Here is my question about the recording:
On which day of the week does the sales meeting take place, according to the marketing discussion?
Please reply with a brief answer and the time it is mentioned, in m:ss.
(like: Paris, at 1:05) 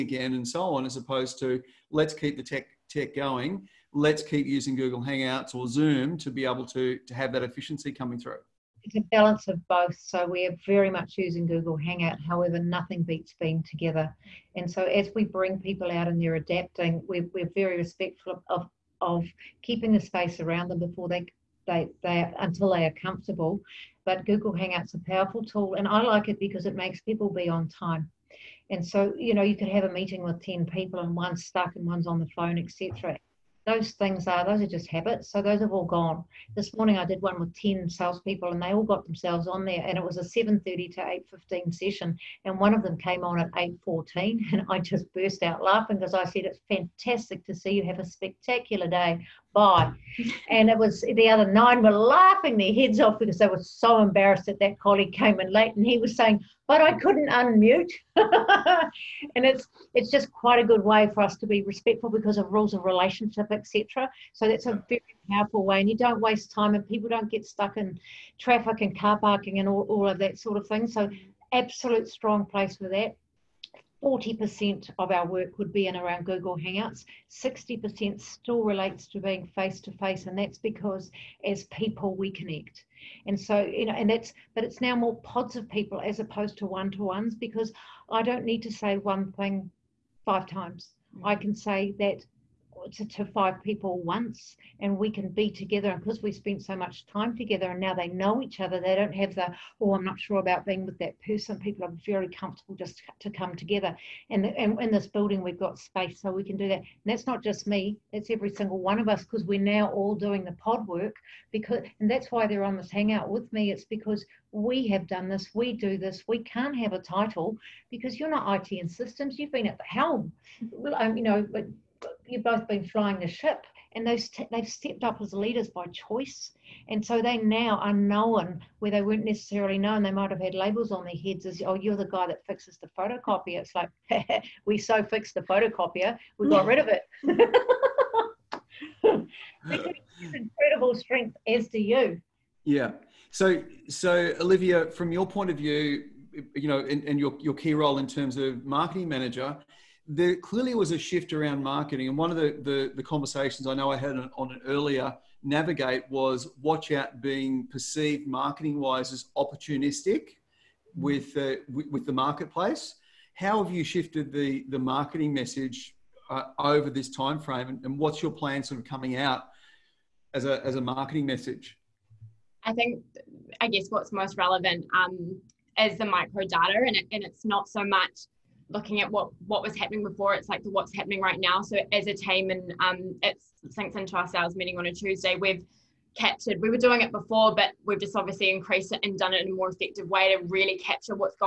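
Tuesday, at 3:04.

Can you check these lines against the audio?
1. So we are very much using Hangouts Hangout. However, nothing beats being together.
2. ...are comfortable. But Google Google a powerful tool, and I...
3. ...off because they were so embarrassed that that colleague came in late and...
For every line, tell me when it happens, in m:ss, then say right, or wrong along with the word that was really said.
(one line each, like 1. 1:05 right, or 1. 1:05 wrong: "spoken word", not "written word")
1. 0:09 wrong: "Google", not "Hangouts"
2. 0:22 wrong: "Hangouts", not "Google"
3. 0:52 right.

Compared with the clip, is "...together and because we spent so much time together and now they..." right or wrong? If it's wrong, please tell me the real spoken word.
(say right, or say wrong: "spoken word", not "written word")
right.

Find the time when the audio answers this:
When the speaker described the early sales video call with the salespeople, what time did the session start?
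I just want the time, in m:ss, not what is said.
0:40.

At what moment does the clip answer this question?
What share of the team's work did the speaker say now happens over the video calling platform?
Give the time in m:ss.
1:14.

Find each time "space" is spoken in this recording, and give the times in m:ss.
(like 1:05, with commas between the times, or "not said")
0:19, 1:45.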